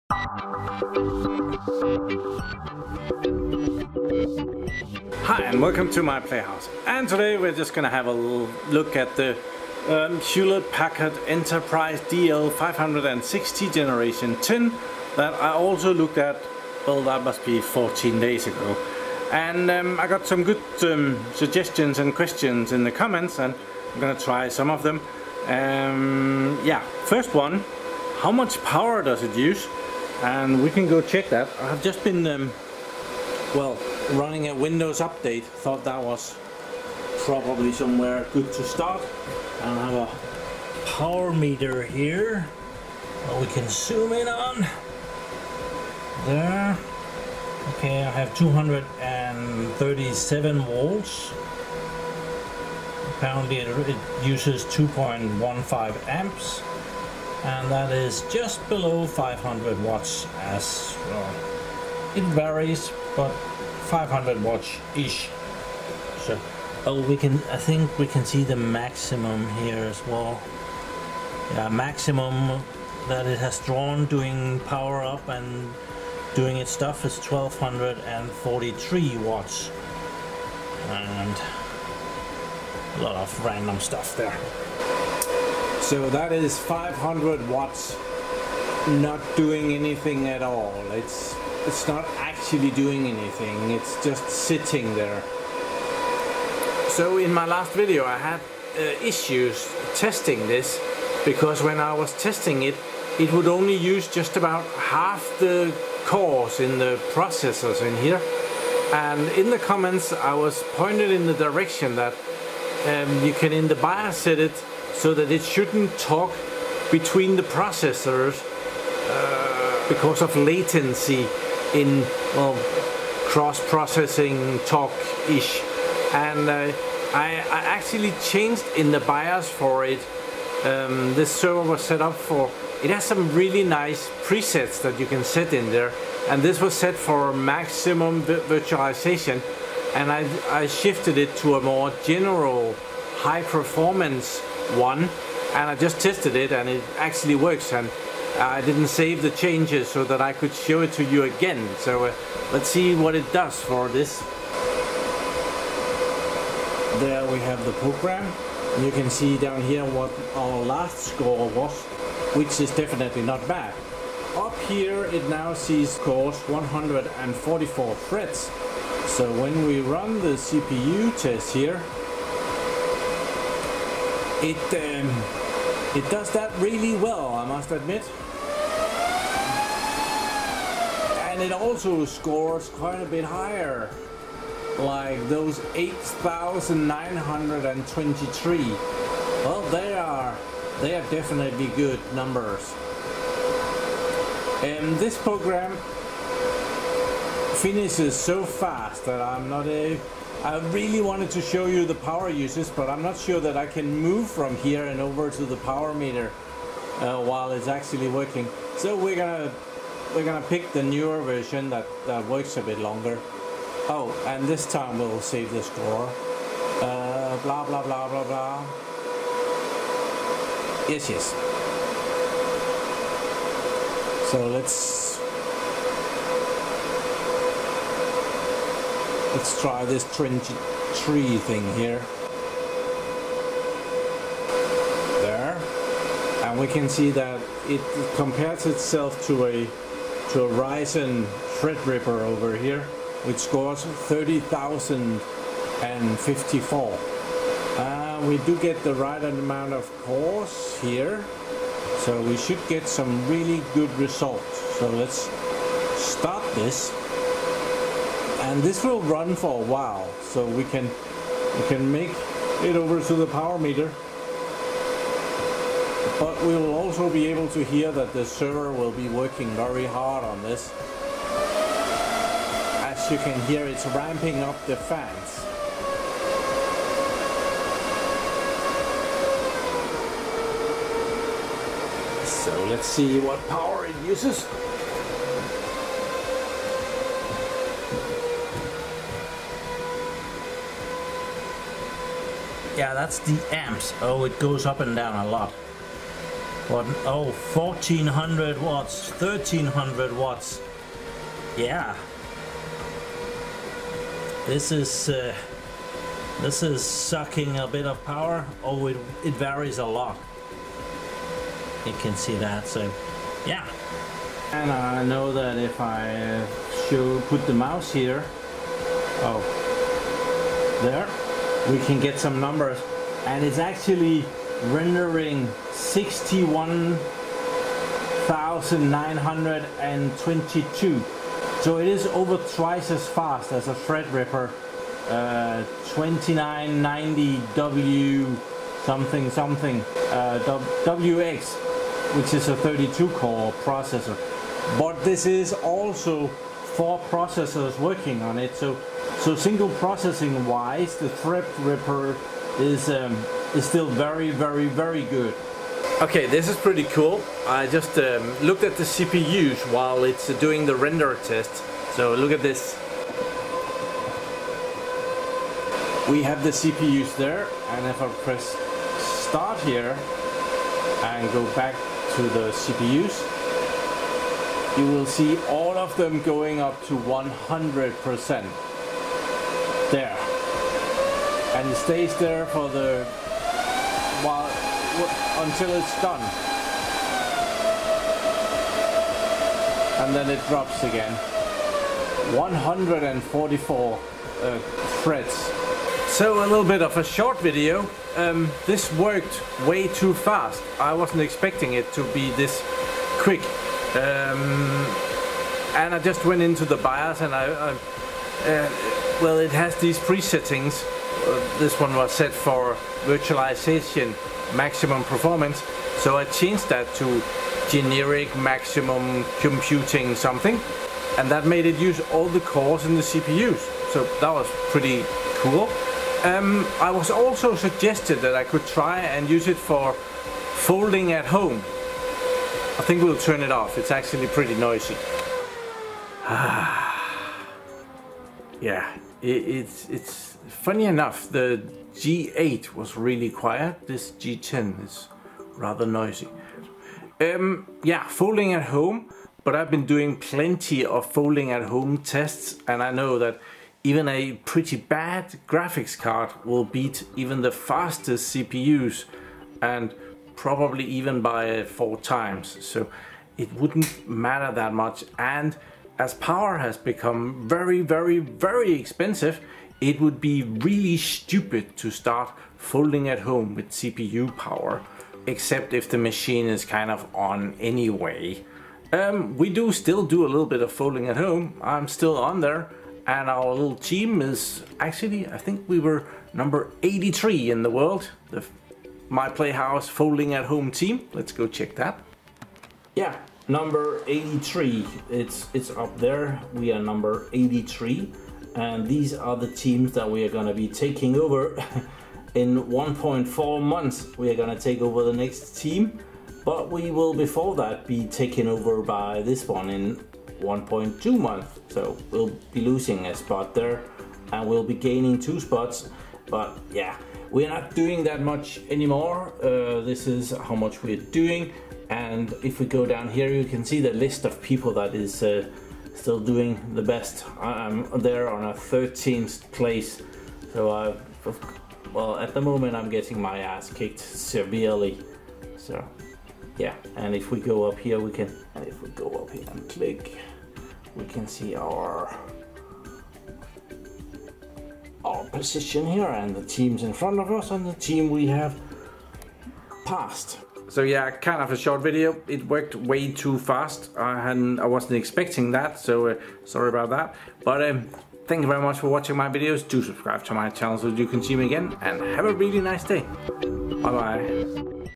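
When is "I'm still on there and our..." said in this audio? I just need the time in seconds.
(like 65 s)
481 s.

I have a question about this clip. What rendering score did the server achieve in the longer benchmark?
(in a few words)
61,922.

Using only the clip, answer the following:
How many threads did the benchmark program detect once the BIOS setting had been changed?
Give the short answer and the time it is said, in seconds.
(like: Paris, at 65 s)
144, at 166 s.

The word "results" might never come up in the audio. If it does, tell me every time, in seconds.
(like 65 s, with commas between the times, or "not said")
253 s.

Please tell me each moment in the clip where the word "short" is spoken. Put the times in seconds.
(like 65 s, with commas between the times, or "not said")
397 s, 551 s.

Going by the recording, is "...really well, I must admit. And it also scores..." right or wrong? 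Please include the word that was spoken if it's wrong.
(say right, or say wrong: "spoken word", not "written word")
right.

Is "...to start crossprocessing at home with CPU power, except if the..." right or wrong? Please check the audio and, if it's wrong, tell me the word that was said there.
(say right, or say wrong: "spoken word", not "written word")
wrong: "folding", not "crossprocessing".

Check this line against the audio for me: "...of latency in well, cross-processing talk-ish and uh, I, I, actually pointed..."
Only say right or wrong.
wrong.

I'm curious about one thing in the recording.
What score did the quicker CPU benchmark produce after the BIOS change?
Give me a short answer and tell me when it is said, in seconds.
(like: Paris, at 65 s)
8,923, at 185 s.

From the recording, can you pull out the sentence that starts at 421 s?
And that made it use all the cores in the CPUs.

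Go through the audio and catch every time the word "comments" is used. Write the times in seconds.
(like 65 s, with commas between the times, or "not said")
22 s, 109 s.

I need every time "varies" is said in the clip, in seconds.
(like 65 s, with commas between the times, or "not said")
62 s, 309 s.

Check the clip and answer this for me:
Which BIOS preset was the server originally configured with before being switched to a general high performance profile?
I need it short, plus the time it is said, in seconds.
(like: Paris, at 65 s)
maximum virtualization, at 137 s.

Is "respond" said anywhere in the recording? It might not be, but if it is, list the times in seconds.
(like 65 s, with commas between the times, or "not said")
not said.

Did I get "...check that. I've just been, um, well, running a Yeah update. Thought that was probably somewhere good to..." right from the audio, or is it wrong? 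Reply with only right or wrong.
wrong.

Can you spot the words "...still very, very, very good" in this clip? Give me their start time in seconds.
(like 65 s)
353 s.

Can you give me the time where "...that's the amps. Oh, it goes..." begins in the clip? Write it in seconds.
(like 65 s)
292 s.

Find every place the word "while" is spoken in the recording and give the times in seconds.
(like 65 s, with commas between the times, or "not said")
207 s, 259 s, 359 s, 384 s.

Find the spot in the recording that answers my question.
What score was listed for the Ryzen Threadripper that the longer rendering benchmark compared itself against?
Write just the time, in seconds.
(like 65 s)
243 s.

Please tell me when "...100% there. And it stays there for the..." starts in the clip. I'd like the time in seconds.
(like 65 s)
376 s.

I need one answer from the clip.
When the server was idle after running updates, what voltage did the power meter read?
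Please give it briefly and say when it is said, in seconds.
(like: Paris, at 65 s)
237 volts, at 48 s.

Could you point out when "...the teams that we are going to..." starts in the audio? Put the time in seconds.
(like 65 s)
499 s.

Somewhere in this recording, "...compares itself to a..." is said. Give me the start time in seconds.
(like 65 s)
238 s.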